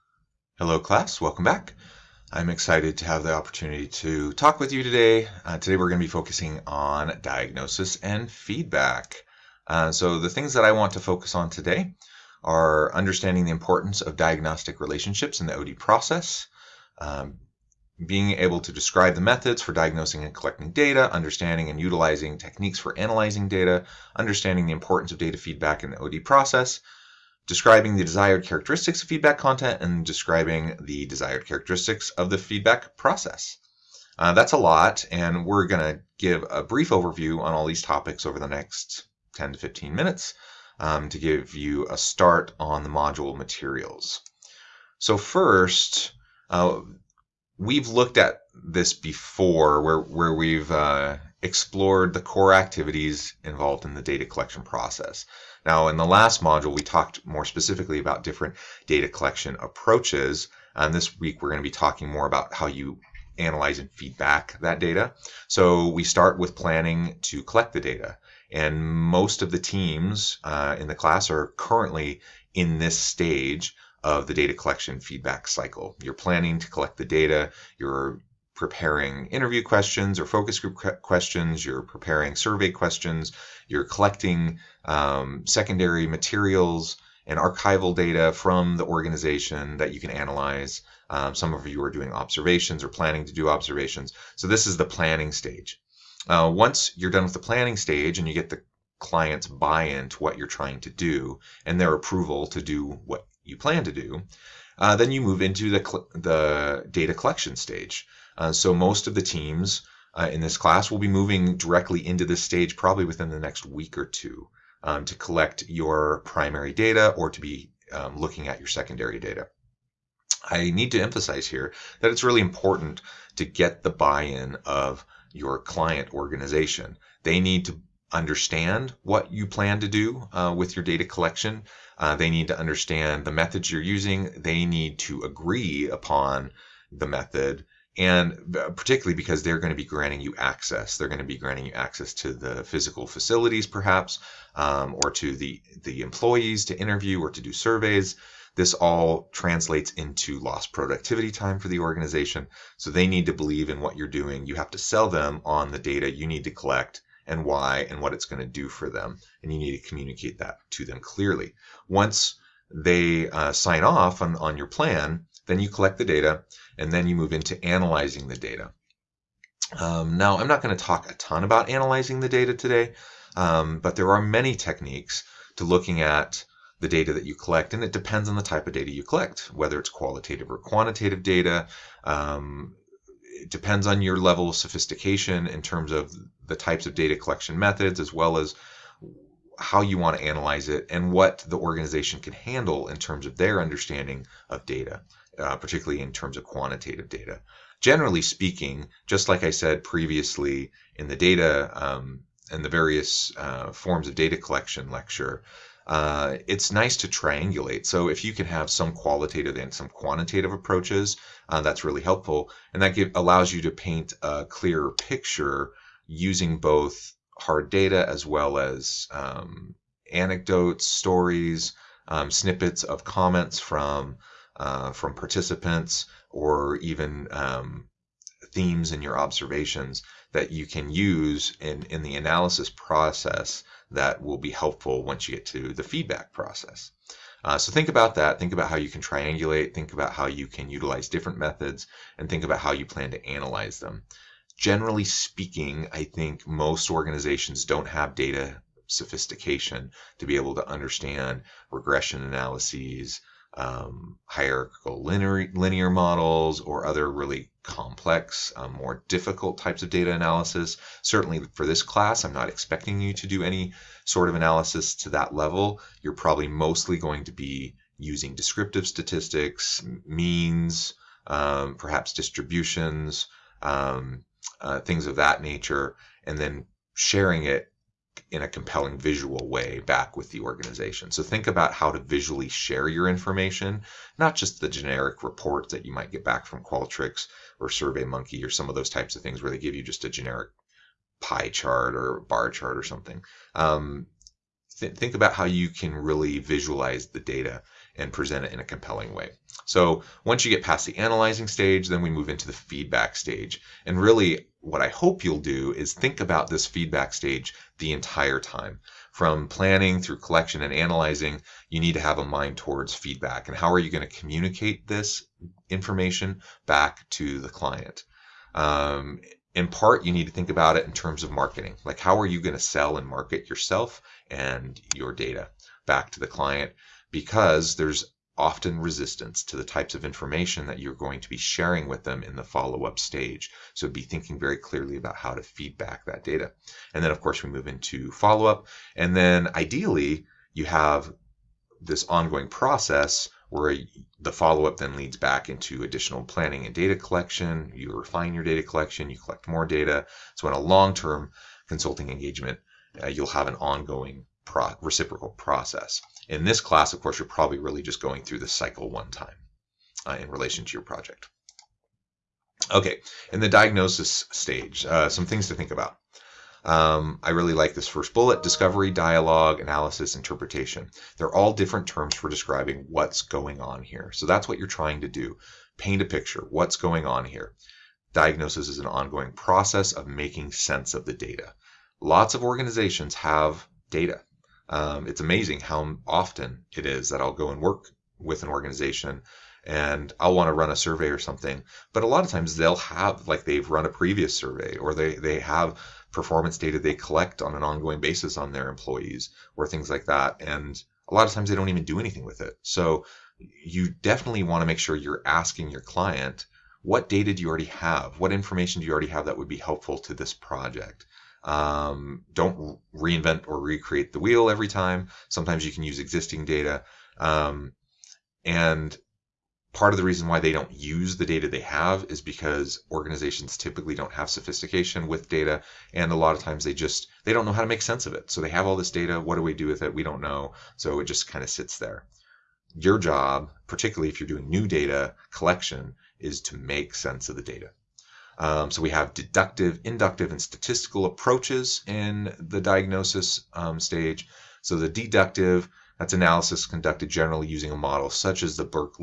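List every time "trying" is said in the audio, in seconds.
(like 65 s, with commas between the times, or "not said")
100 s, 374 s.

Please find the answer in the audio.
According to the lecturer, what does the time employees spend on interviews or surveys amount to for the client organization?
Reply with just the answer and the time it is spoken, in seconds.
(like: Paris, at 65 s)
lost productivity time, at 150 s.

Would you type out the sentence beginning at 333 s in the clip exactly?
So be thinking very clearly about how to feedback that data.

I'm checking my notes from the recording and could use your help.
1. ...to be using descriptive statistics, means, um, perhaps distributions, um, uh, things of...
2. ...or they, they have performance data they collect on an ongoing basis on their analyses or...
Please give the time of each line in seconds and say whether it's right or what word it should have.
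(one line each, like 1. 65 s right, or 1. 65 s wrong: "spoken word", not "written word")
1. 267 s right
2. 394 s wrong: "employees", not "analyses".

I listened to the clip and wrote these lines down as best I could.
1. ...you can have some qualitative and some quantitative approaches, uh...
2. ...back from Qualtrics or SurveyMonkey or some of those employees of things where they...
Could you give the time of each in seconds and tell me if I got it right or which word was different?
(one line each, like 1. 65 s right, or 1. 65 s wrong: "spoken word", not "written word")
1. 208 s right
2. 286 s wrong: "types", not "employees".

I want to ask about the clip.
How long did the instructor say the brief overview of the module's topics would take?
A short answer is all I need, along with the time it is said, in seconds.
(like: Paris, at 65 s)
10 to 15 minutes, at 39 s.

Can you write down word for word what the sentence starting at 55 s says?
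Now, in the last module, we talked more specifically about different data collection approaches.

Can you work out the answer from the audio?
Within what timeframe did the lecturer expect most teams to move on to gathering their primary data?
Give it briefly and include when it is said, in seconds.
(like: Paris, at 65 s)
next week or two, at 113 s.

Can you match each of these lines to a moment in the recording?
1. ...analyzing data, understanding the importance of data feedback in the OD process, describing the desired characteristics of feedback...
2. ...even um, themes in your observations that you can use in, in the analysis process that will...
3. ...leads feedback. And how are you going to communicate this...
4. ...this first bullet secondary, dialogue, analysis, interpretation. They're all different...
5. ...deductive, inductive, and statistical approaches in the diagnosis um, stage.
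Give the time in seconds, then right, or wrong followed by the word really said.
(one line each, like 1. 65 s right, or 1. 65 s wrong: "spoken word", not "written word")
1. 22 s right
2. 226 s right
3. 312 s wrong: "towards", not "leads"
4. 367 s wrong: "discovery", not "secondary"
5. 439 s right.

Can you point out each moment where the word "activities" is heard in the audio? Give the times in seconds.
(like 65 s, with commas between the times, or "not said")
52 s.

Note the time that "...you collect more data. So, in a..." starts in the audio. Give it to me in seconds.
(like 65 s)
349 s.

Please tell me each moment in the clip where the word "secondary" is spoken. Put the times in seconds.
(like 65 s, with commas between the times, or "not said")
85 s, 118 s.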